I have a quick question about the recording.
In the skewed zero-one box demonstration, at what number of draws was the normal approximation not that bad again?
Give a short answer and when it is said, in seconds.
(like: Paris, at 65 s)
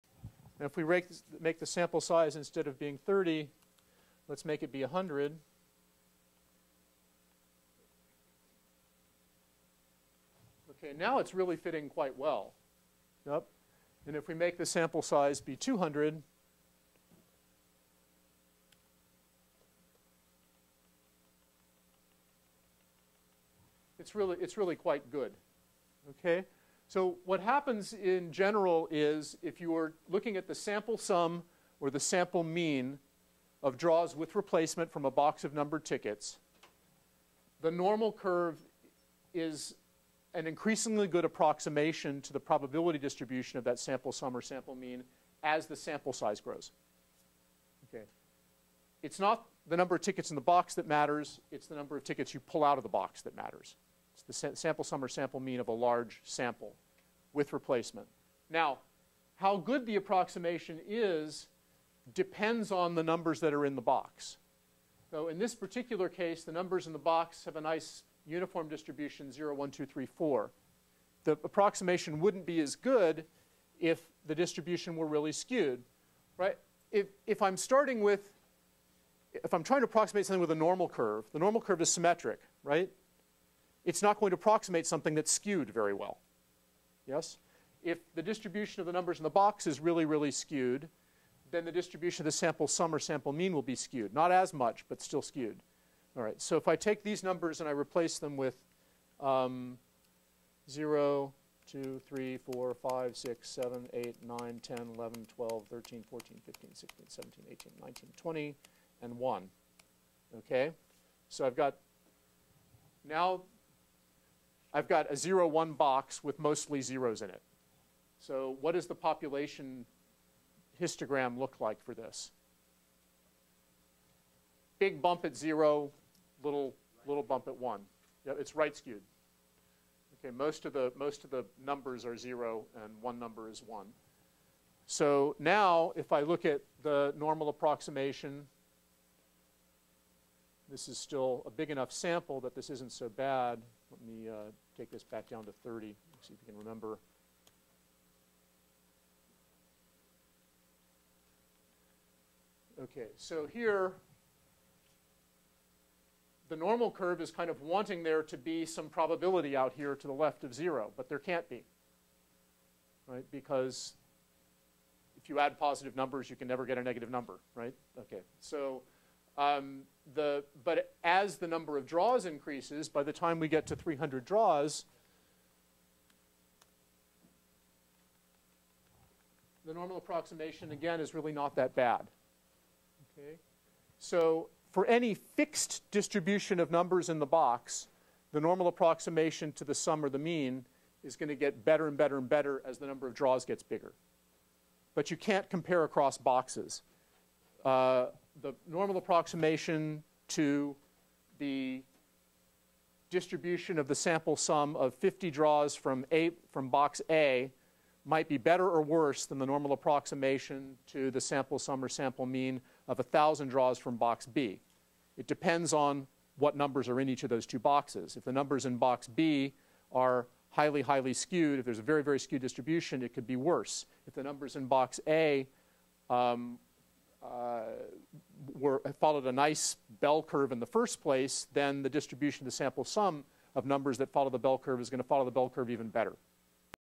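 300, at 173 s.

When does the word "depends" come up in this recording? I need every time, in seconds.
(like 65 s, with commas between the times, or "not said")
62 s, 215 s.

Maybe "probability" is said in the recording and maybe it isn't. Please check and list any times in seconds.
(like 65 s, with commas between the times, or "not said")
42 s, 158 s.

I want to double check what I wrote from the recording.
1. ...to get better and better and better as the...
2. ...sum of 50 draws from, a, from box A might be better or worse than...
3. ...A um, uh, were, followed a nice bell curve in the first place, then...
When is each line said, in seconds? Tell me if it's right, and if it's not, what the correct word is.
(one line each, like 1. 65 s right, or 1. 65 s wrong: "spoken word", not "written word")
1. 191 s right
2. 204 s right
3. 225 s right.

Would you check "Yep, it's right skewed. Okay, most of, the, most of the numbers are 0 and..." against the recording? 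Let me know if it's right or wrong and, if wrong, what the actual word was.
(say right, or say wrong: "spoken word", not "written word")
right.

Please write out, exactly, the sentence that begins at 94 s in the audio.
Not as much, but still skewed.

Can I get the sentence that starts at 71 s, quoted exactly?
The approximation wouldn't be as good if the distribution were really skewed.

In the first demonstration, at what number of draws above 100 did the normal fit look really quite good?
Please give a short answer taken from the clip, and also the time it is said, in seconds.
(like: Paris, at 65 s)
200, at 15 s.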